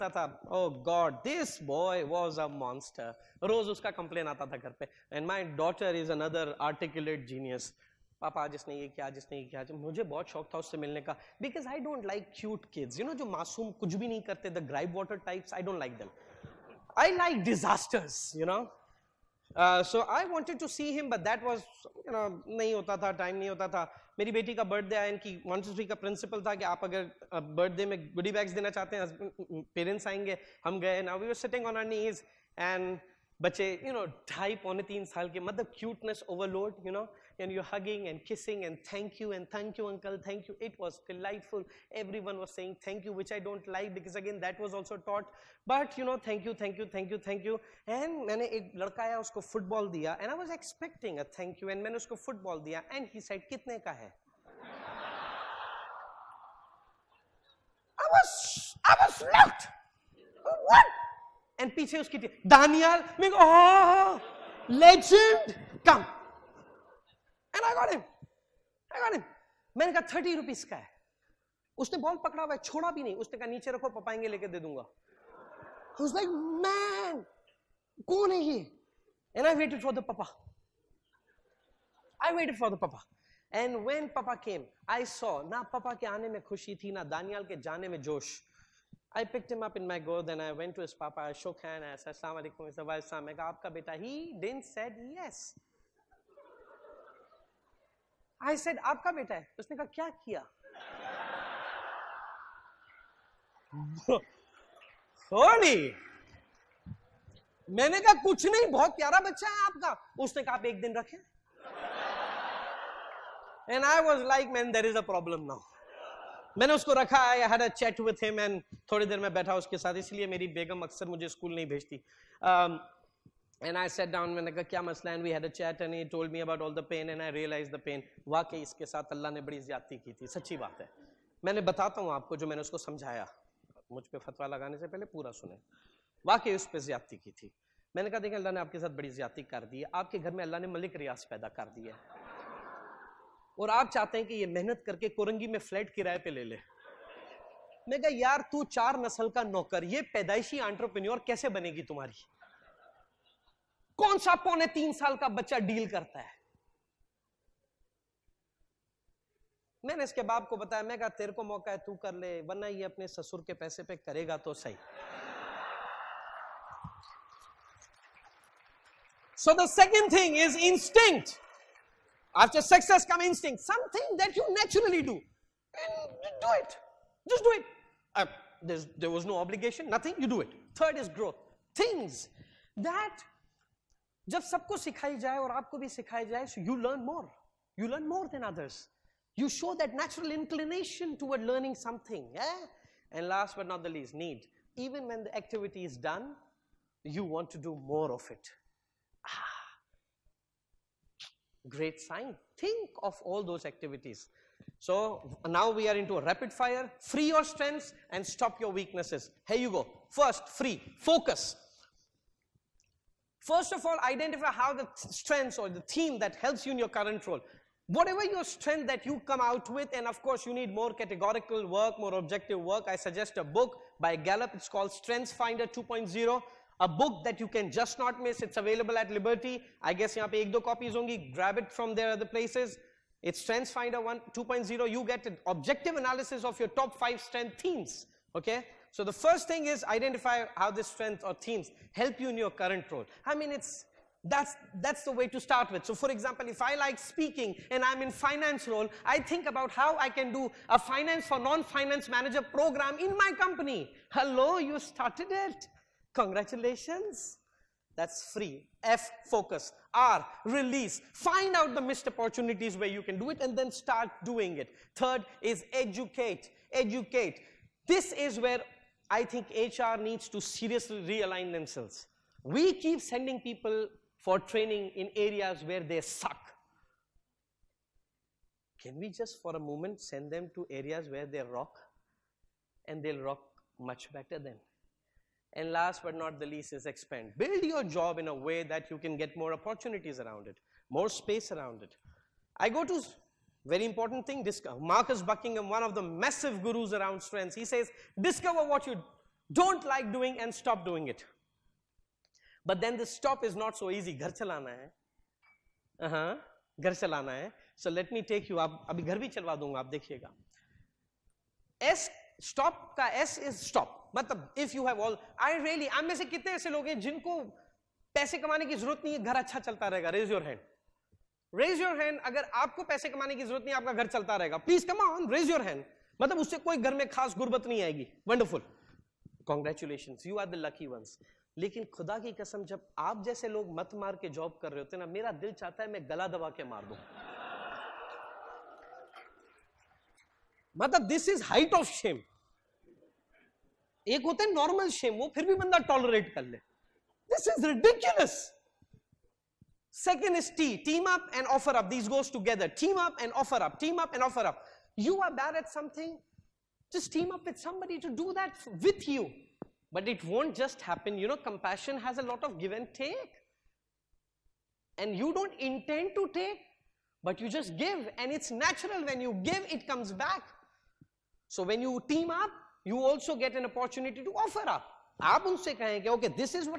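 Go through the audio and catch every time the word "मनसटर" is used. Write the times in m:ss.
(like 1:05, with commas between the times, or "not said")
0:02.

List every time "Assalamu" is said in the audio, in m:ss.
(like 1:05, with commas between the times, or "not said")
1:32.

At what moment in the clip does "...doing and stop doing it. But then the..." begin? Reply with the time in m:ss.
5:00.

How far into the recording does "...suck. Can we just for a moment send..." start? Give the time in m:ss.
4:36.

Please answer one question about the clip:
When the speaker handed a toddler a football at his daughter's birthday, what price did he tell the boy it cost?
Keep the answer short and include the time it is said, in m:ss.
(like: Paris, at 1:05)
30 rupees, at 1:10.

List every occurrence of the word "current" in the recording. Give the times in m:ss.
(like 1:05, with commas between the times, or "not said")
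3:36, 4:02.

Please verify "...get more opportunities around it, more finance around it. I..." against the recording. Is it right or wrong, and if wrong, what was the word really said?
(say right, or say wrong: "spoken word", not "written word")
wrong: "space", not "finance".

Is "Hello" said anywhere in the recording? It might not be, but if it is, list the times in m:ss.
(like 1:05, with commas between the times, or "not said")
4:14.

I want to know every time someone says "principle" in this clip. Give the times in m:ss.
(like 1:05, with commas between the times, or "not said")
0:26.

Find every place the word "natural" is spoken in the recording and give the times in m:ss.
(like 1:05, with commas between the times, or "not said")
3:09, 6:08.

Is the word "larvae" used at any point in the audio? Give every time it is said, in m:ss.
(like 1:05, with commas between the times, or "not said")
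not said.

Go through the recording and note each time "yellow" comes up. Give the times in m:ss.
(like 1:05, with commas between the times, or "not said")
not said.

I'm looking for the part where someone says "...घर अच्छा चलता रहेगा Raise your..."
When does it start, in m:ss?
5:19.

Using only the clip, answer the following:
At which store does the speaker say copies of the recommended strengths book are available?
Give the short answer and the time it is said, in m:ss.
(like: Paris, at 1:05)
Liberty, at 3:49.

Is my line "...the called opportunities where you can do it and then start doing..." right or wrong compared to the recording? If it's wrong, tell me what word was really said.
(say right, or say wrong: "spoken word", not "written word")
wrong: "missed", not "called".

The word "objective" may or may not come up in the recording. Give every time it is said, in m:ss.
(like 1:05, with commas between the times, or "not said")
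3:42, 3:55.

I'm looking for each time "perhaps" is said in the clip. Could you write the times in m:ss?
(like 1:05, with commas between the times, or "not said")
not said.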